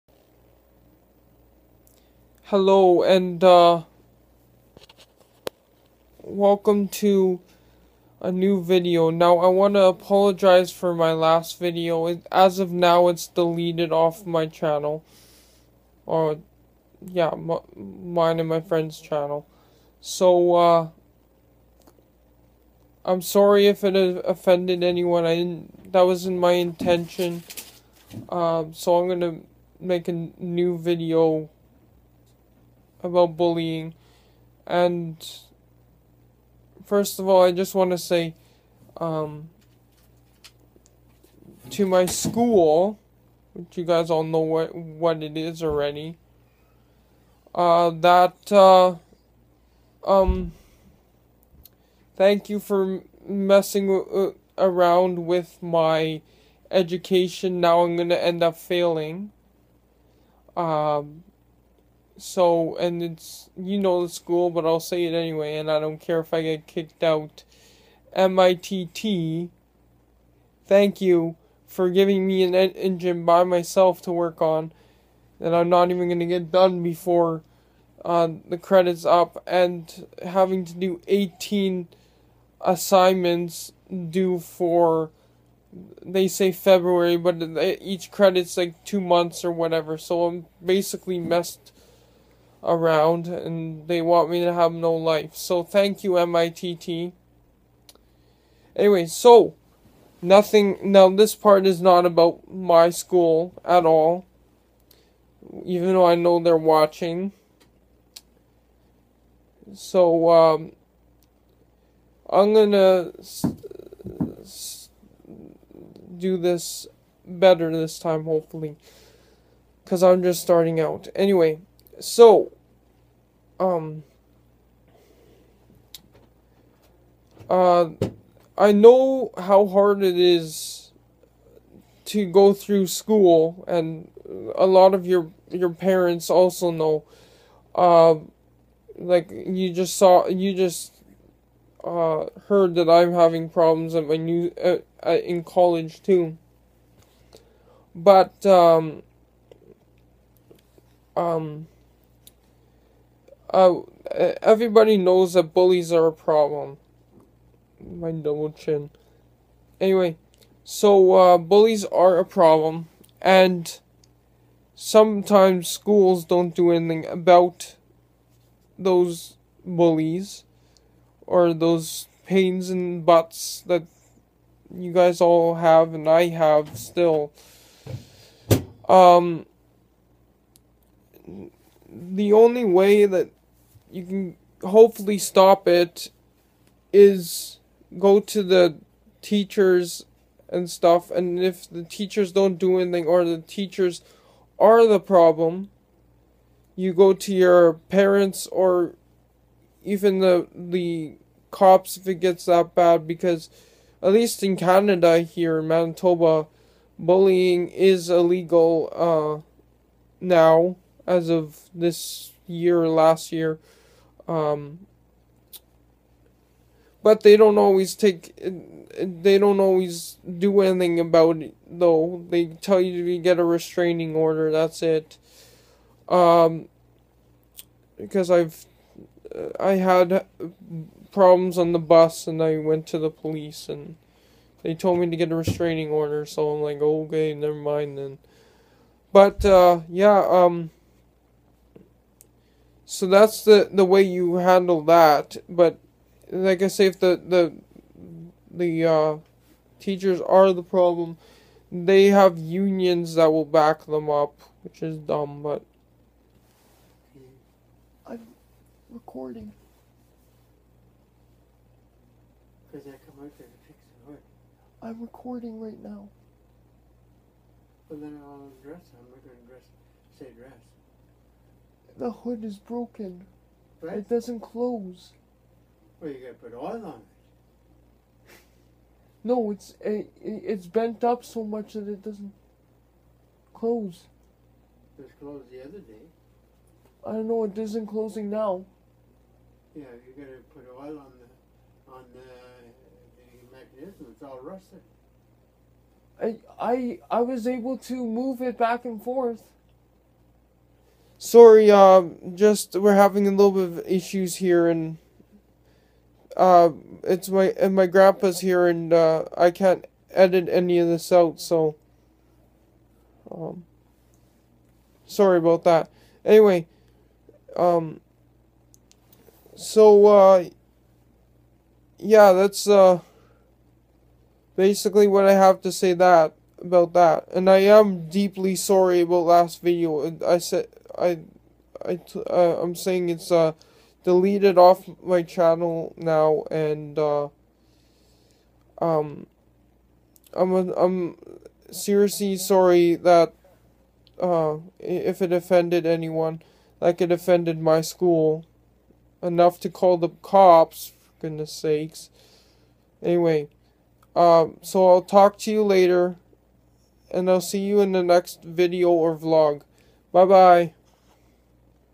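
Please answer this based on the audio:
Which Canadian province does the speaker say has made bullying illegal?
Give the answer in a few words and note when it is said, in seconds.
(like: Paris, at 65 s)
Manitoba, at 205 s.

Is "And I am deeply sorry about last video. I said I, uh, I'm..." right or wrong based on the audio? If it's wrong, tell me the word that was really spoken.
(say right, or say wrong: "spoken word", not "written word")
right.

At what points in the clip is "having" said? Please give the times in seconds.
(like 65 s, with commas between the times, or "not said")
80 s, 143 s, 302 s.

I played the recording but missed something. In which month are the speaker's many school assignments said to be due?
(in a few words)
February.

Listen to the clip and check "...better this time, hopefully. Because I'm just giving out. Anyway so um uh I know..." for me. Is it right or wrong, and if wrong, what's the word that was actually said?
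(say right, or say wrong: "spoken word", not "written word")
wrong: "starting", not "giving".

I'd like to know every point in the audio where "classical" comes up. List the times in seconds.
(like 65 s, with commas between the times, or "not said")
not said.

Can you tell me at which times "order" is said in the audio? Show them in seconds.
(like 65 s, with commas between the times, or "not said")
224 s, 235 s.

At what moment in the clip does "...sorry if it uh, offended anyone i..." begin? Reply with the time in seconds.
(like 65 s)
23 s.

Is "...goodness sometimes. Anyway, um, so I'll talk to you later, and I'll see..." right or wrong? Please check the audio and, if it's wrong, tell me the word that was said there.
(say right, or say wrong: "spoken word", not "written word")
wrong: "sakes", not "sometimes".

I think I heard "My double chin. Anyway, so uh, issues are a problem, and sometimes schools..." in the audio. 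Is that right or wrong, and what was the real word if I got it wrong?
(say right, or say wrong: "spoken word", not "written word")
wrong: "bullies", not "issues".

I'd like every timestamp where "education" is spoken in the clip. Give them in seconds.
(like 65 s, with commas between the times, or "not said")
56 s.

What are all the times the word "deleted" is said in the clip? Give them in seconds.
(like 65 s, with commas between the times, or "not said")
13 s, 334 s.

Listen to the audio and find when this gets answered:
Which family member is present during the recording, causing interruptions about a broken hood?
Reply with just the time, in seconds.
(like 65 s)
307 s.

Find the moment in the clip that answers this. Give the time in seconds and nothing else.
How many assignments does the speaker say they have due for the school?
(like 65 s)
81 s.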